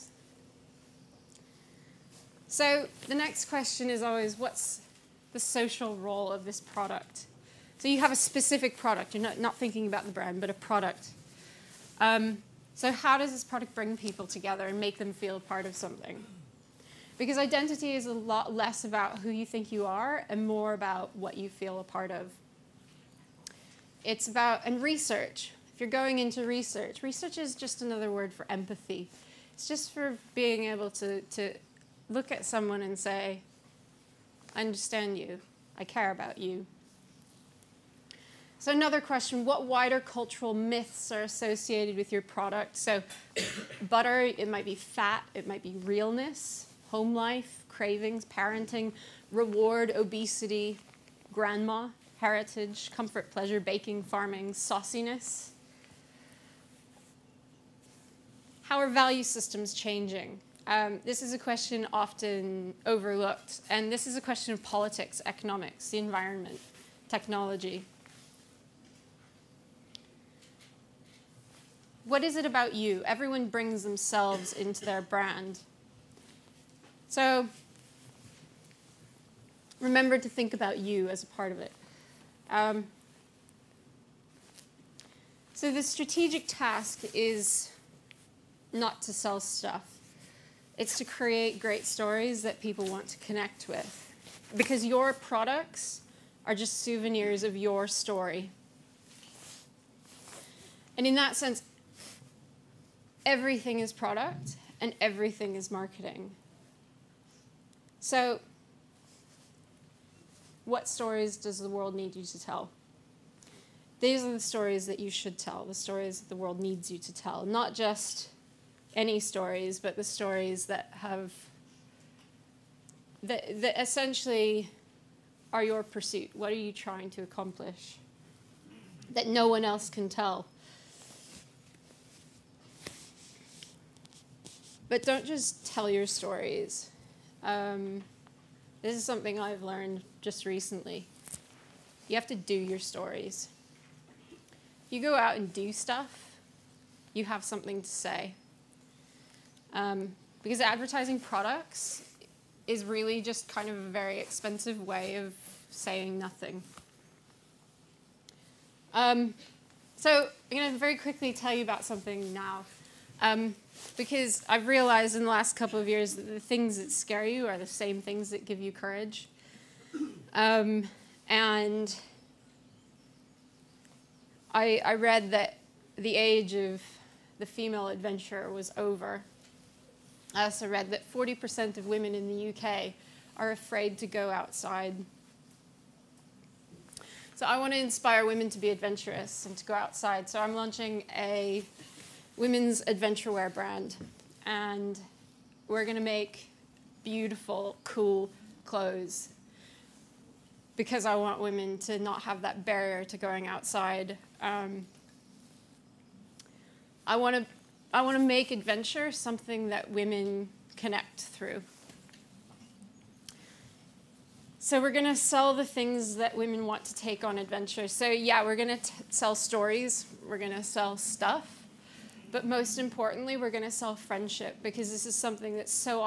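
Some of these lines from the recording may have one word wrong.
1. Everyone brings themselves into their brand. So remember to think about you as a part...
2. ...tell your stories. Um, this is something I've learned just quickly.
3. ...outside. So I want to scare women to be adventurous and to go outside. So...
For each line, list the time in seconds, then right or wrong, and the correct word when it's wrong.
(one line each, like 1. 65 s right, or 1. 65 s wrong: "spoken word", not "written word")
1. 73 s right
2. 135 s wrong: "recently", not "quickly"
3. 184 s wrong: "inspire", not "scare".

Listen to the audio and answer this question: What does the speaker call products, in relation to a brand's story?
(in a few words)
Souvenirs.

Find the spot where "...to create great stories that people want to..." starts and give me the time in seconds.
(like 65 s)
90 s.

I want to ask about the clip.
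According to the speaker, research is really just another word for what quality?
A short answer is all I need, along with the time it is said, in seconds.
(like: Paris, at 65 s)
Empathy, at 28 s.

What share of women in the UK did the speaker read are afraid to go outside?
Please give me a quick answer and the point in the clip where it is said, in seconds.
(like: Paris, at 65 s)
40%, at 181 s.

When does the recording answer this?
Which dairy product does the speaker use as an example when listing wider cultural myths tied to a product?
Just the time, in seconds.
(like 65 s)
43 s.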